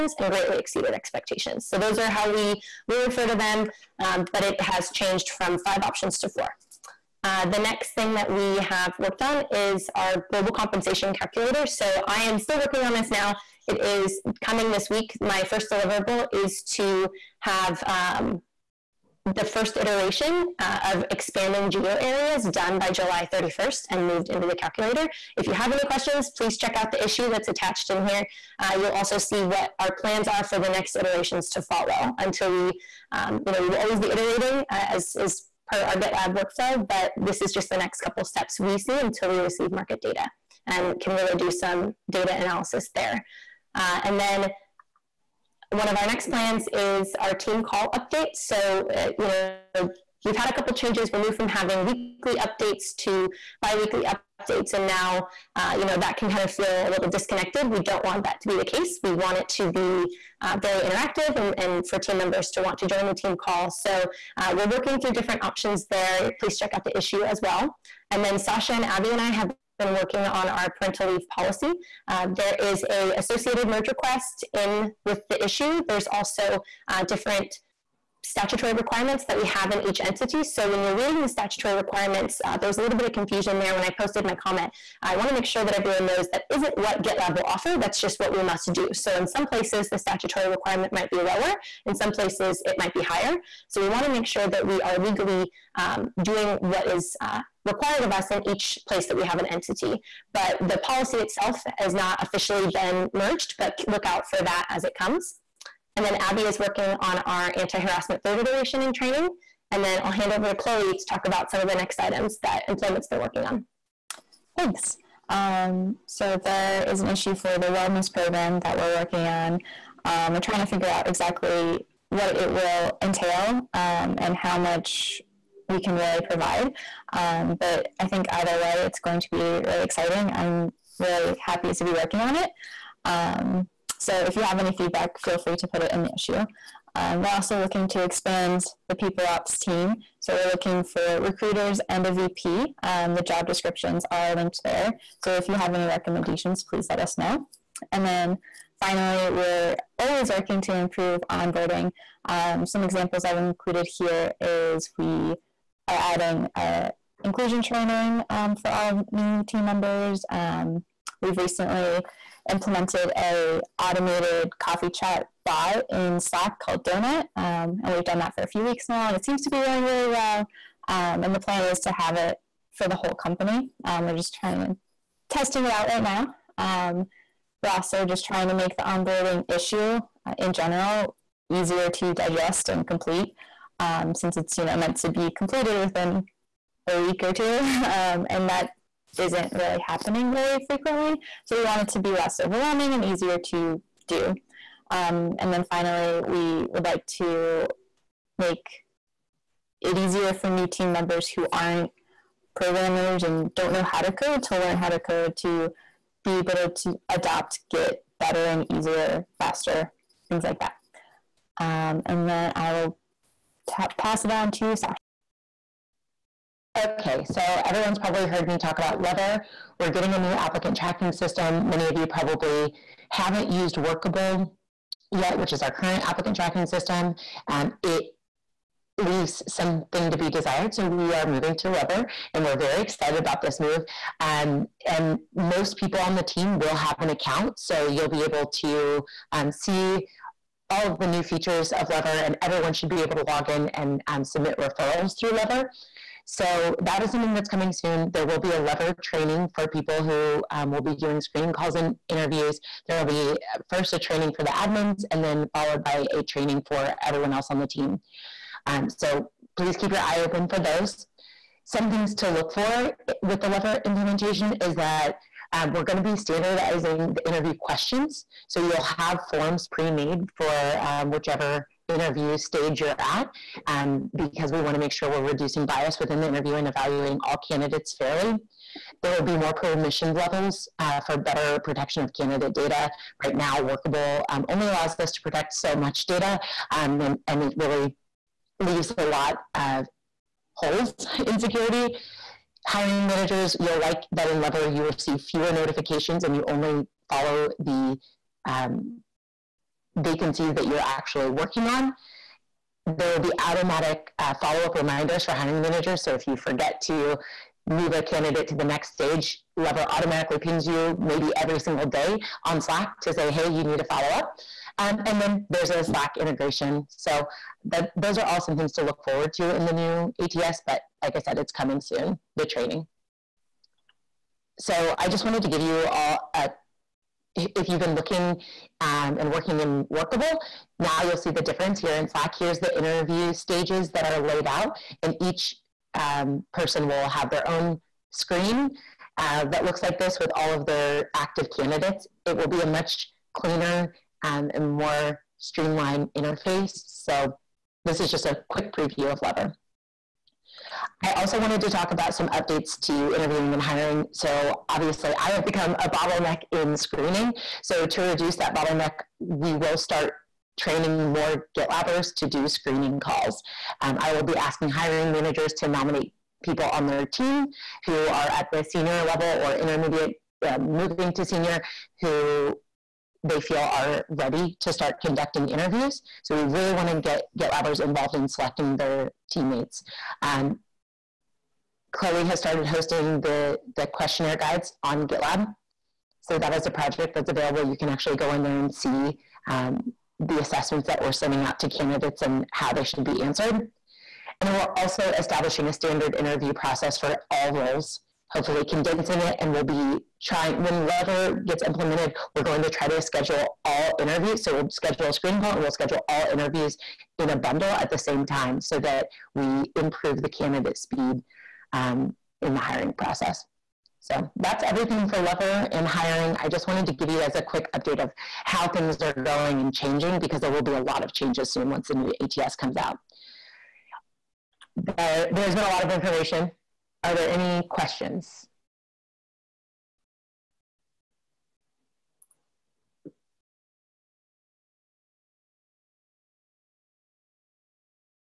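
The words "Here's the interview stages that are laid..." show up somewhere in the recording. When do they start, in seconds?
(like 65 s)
332 s.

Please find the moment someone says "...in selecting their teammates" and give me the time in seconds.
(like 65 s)
378 s.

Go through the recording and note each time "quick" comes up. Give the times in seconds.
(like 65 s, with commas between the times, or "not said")
348 s, 417 s.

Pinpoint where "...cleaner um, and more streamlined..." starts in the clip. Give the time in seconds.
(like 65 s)
343 s.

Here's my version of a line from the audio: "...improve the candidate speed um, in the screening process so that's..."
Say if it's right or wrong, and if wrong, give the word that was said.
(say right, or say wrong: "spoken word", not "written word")
wrong: "hiring", not "screening".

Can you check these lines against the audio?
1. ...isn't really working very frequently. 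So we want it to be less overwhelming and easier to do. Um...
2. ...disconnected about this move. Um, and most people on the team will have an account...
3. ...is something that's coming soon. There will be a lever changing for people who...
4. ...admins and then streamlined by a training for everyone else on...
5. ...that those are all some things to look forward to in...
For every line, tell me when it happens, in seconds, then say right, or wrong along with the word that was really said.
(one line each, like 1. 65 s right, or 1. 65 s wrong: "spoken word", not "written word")
1. 189 s wrong: "happening", not "working"
2. 232 s wrong: "excited", not "disconnected"
3. 247 s wrong: "training", not "changing"
4. 254 s wrong: "followed", not "streamlined"
5. 317 s right.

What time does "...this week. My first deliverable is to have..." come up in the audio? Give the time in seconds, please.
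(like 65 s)
14 s.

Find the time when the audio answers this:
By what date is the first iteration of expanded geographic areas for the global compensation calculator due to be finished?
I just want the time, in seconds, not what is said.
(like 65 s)
22 s.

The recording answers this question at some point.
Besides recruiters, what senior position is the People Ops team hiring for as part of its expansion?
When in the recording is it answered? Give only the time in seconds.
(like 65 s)
142 s.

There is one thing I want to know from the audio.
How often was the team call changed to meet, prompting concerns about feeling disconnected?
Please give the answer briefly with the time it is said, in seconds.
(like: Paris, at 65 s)
Biweekly, at 53 s.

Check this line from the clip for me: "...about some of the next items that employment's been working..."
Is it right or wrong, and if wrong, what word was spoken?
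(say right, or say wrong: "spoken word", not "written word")
right.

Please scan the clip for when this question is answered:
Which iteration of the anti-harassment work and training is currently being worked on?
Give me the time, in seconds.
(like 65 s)
108 s.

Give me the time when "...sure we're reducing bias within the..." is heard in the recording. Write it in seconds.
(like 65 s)
274 s.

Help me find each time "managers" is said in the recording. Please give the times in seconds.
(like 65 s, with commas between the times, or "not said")
293 s, 305 s, 365 s.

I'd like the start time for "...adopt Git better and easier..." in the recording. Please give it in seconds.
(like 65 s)
207 s.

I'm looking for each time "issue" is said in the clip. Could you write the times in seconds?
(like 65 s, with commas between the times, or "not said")
27 s, 66 s, 75 s, 117 s, 136 s, 179 s.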